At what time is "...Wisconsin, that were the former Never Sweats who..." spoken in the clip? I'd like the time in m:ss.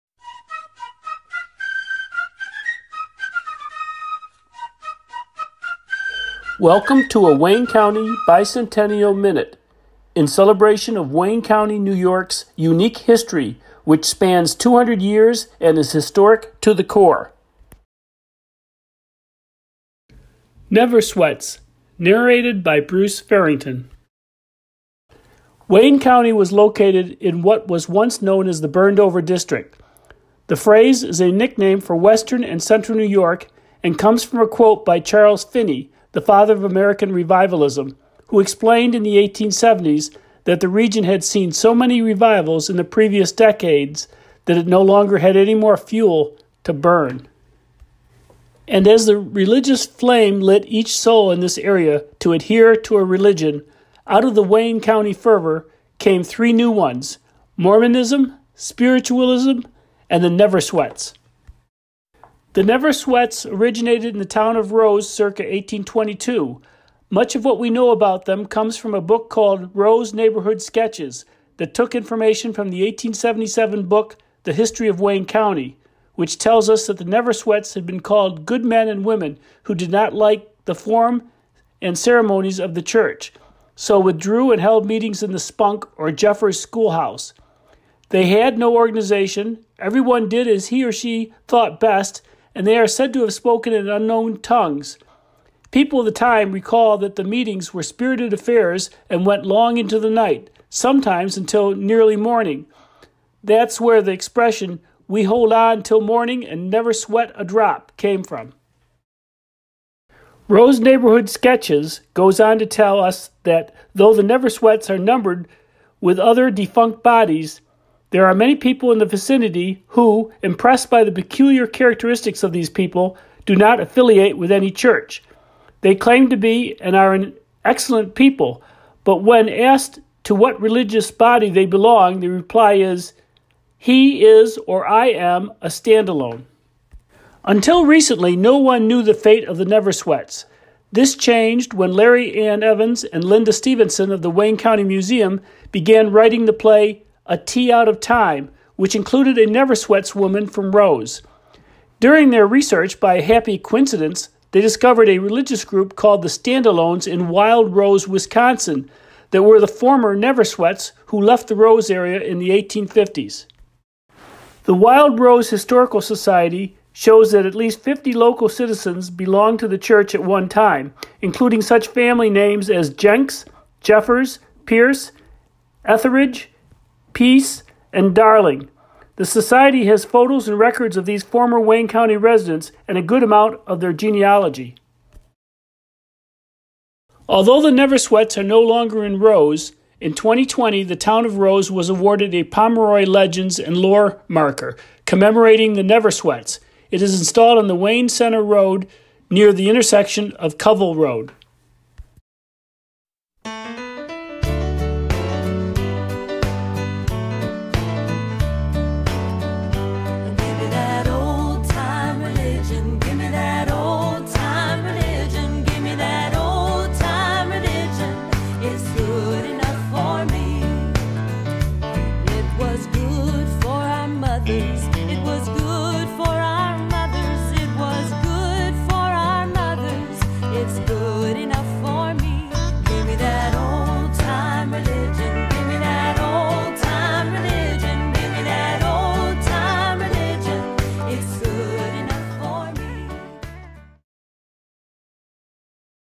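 2:38.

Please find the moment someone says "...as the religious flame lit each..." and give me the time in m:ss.
0:48.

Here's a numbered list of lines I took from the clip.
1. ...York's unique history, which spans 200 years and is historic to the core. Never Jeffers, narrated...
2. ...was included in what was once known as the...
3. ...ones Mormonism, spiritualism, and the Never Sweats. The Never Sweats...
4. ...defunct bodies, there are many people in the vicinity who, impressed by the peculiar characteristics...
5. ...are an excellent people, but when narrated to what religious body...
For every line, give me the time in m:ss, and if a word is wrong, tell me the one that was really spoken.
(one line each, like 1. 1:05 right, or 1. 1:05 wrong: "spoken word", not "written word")
1. 0:11 wrong: "Sweats", not "Jeffers"
2. 0:26 wrong: "located", not "included"
3. 0:56 right
4. 1:56 right
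5. 2:06 wrong: "asked", not "narrated".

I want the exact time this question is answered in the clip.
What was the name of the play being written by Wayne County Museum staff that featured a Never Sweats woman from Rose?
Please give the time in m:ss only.
2:27.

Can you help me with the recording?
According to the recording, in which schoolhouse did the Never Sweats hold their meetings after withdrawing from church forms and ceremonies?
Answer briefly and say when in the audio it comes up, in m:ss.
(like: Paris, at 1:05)
Spunk or Jeffers schoolhouse, at 1:25.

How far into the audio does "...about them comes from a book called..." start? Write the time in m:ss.
1:07.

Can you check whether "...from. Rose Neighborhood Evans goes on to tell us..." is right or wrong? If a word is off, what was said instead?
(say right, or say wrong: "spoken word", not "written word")
wrong: "Sketches", not "Evans".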